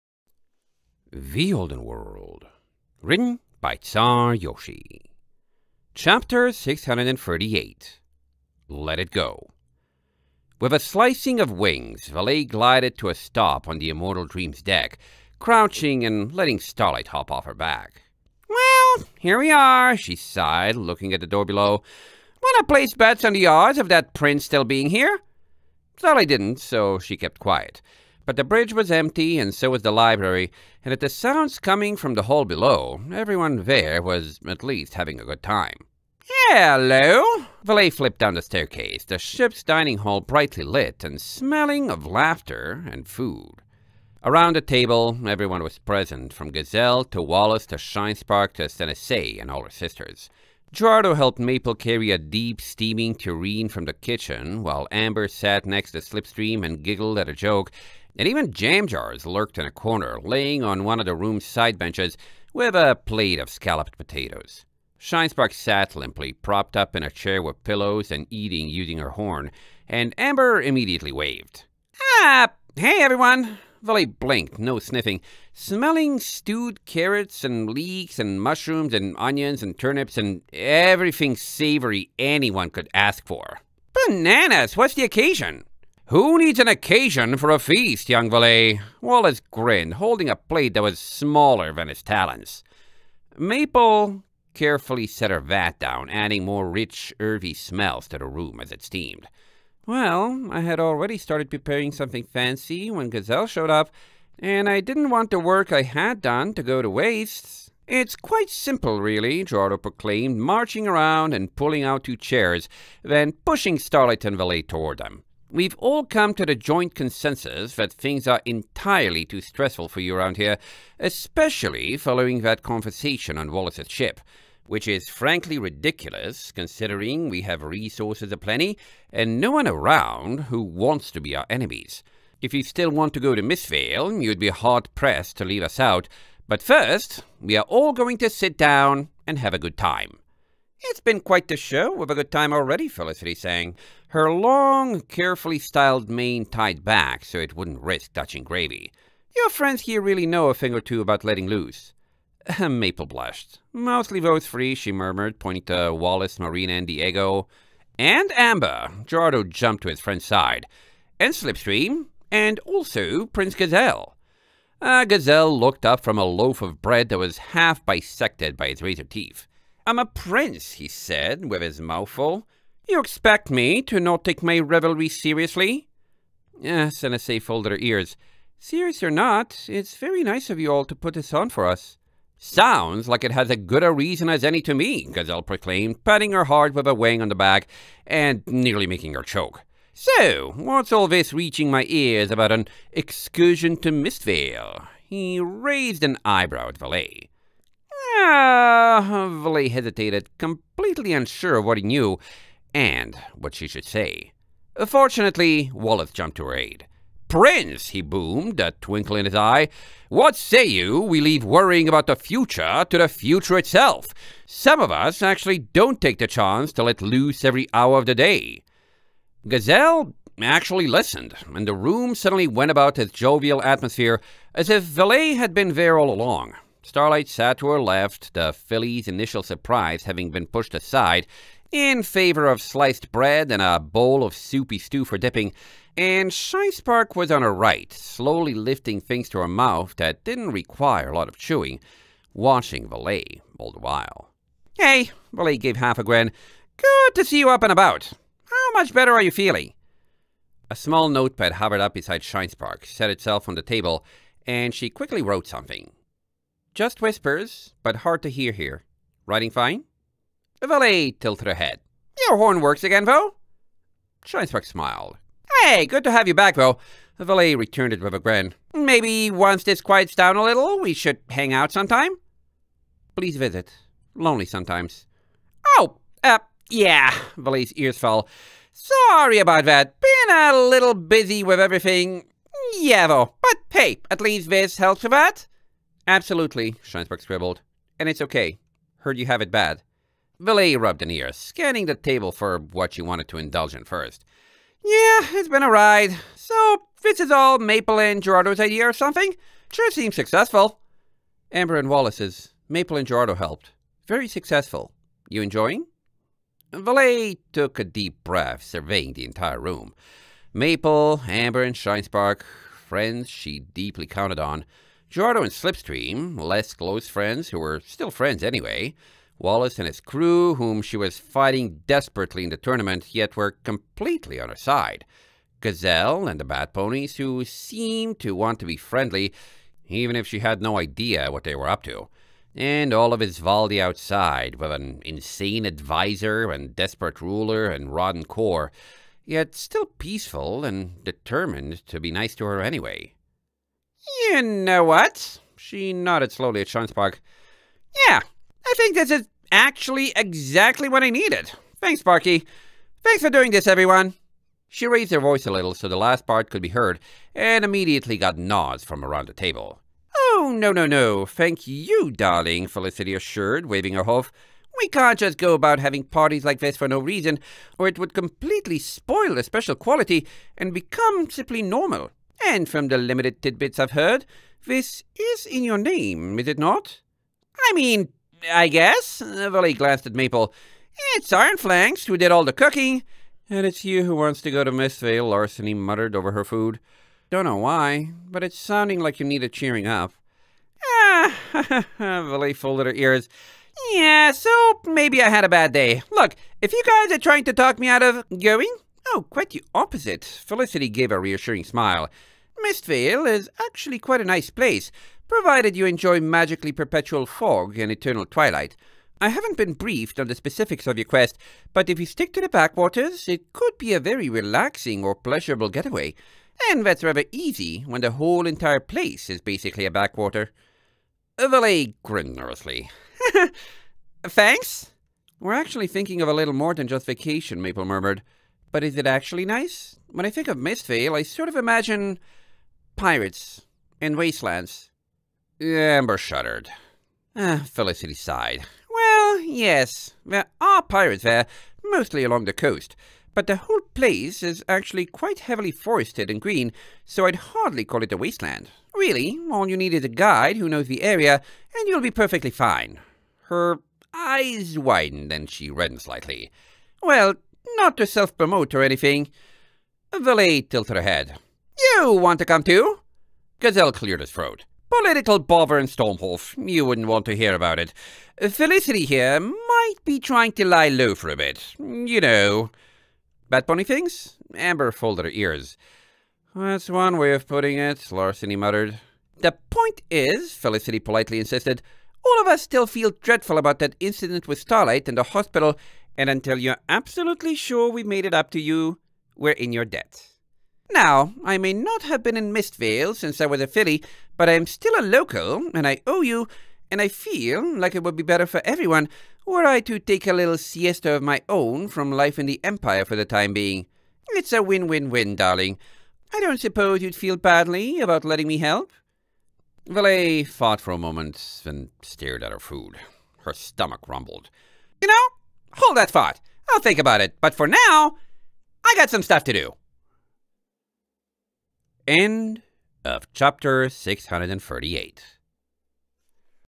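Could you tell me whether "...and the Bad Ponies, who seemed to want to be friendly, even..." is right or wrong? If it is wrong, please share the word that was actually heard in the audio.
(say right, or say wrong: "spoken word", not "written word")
right.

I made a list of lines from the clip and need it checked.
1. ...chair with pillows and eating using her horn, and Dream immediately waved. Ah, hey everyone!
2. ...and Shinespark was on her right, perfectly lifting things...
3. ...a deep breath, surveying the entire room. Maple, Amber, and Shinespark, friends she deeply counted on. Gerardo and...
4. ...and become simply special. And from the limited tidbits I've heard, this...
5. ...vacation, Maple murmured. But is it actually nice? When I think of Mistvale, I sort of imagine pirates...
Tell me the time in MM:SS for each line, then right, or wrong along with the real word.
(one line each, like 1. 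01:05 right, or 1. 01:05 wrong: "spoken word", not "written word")
1. 01:07 wrong: "Amber", not "Dream"
2. 03:55 wrong: "slowly", not "perfectly"
3. 05:07 right
4. 06:10 wrong: "normal", not "special"
5. 07:07 right.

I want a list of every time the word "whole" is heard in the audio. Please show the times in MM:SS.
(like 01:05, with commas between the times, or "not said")
06:58, 07:23.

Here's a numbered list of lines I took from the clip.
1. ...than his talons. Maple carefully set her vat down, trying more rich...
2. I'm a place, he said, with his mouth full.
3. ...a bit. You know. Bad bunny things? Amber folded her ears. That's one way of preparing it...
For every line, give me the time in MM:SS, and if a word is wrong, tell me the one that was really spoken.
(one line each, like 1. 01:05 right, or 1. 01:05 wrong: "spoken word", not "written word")
1. 01:31 wrong: "adding", not "trying"
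2. 02:49 wrong: "prince", not "place"
3. 07:51 wrong: "putting", not "preparing".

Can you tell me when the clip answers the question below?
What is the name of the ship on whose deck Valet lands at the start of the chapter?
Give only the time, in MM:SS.
00:13.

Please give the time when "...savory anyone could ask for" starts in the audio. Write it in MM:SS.
01:21.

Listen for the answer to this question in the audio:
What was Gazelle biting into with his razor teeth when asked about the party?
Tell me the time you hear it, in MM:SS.
02:46.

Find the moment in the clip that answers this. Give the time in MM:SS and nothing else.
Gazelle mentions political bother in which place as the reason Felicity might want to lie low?
07:45.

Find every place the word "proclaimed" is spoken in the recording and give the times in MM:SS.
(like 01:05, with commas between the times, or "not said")
01:49, 03:05.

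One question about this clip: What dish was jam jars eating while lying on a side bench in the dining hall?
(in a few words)
scalloped potatoes.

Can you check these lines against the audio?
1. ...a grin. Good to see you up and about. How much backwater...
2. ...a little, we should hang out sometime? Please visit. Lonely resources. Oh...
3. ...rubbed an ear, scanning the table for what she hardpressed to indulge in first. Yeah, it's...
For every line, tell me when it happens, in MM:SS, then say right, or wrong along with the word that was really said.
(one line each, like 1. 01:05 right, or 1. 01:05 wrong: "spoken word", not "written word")
1. 04:05 wrong: "better", not "backwater"
2. 04:30 wrong: "sometimes", not "resources"
3. 04:50 wrong: "wanted", not "hardpressed".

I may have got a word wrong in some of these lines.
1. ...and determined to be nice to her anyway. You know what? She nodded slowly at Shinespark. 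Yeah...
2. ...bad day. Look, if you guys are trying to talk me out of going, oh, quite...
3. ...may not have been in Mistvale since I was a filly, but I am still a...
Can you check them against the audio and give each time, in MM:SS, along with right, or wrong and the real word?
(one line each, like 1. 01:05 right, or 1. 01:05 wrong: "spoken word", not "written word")
1. 05:40 right
2. 06:35 right
3. 08:11 right.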